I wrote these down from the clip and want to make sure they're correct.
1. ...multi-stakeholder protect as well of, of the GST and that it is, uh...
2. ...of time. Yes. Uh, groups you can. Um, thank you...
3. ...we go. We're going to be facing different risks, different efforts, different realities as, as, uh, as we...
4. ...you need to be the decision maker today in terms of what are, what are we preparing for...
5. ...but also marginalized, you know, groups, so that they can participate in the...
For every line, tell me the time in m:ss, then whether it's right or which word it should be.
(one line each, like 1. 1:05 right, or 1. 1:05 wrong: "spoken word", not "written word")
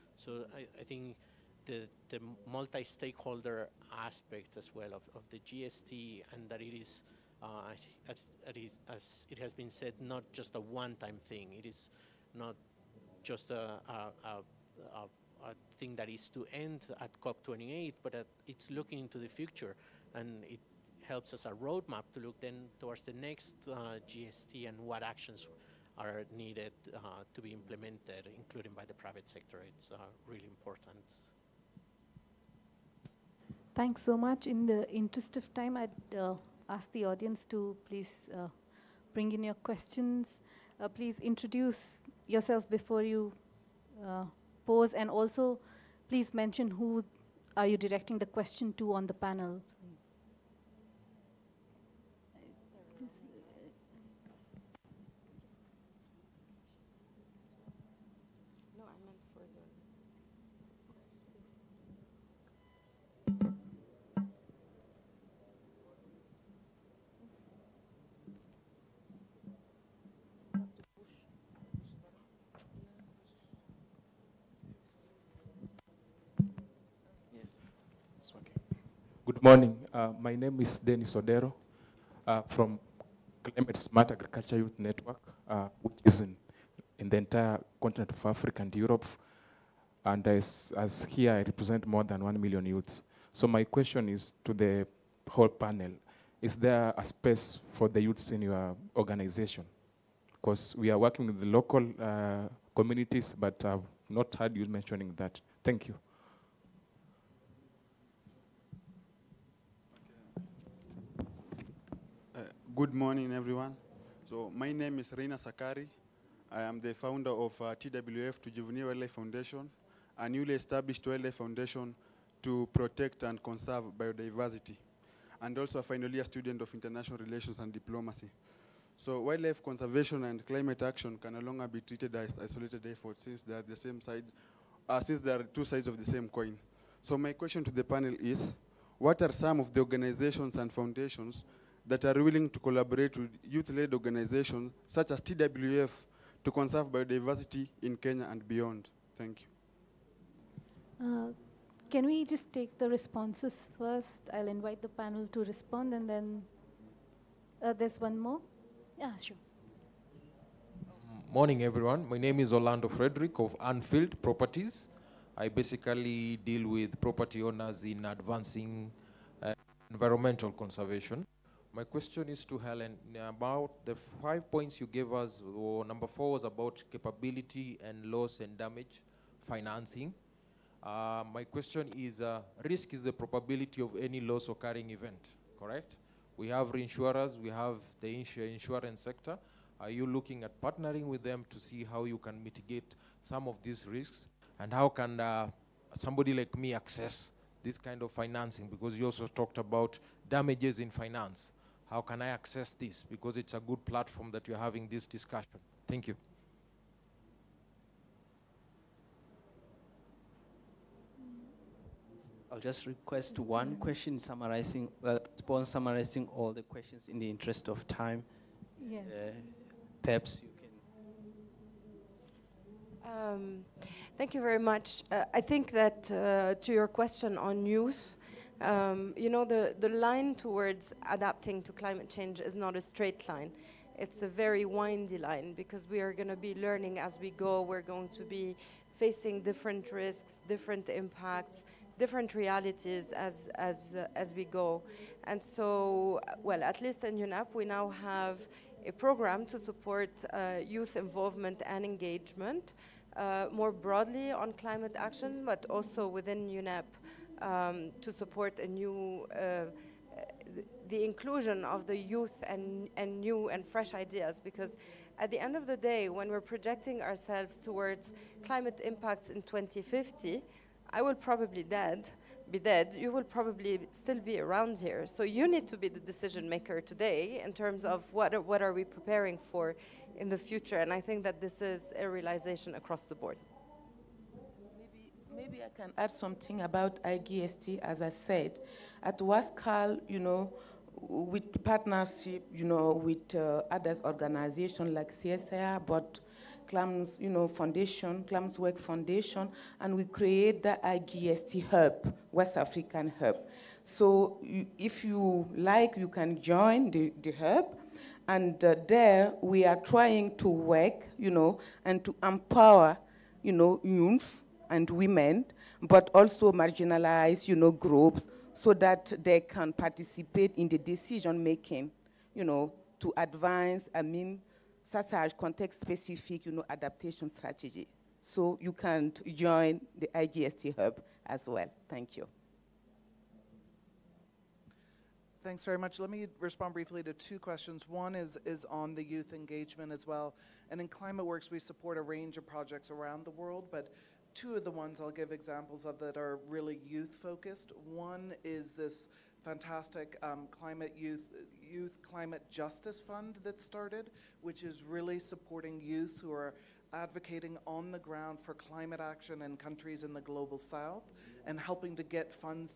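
1. 0:02 wrong: "aspect", not "protect"
2. 3:37 wrong: "perhaps", not "groups"
3. 3:57 wrong: "impacts", not "efforts"
4. 4:35 right
5. 5:15 right.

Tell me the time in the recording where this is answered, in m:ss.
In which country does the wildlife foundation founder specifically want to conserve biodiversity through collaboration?
2:27.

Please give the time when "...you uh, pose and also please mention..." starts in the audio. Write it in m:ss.
0:43.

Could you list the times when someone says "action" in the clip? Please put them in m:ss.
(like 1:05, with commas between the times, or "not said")
0:25, 2:10, 4:14, 5:59.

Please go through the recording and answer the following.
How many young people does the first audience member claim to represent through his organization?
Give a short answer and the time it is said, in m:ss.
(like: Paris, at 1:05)
1 million, at 1:32.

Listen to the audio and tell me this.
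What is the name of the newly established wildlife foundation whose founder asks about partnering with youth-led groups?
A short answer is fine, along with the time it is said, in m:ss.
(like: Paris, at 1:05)
TWF Juvenile Wildlife Foundation, at 1:57.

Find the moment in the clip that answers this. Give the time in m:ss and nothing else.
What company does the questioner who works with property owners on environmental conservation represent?
2:43.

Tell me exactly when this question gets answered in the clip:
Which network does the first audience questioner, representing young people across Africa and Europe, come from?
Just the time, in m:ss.
1:23.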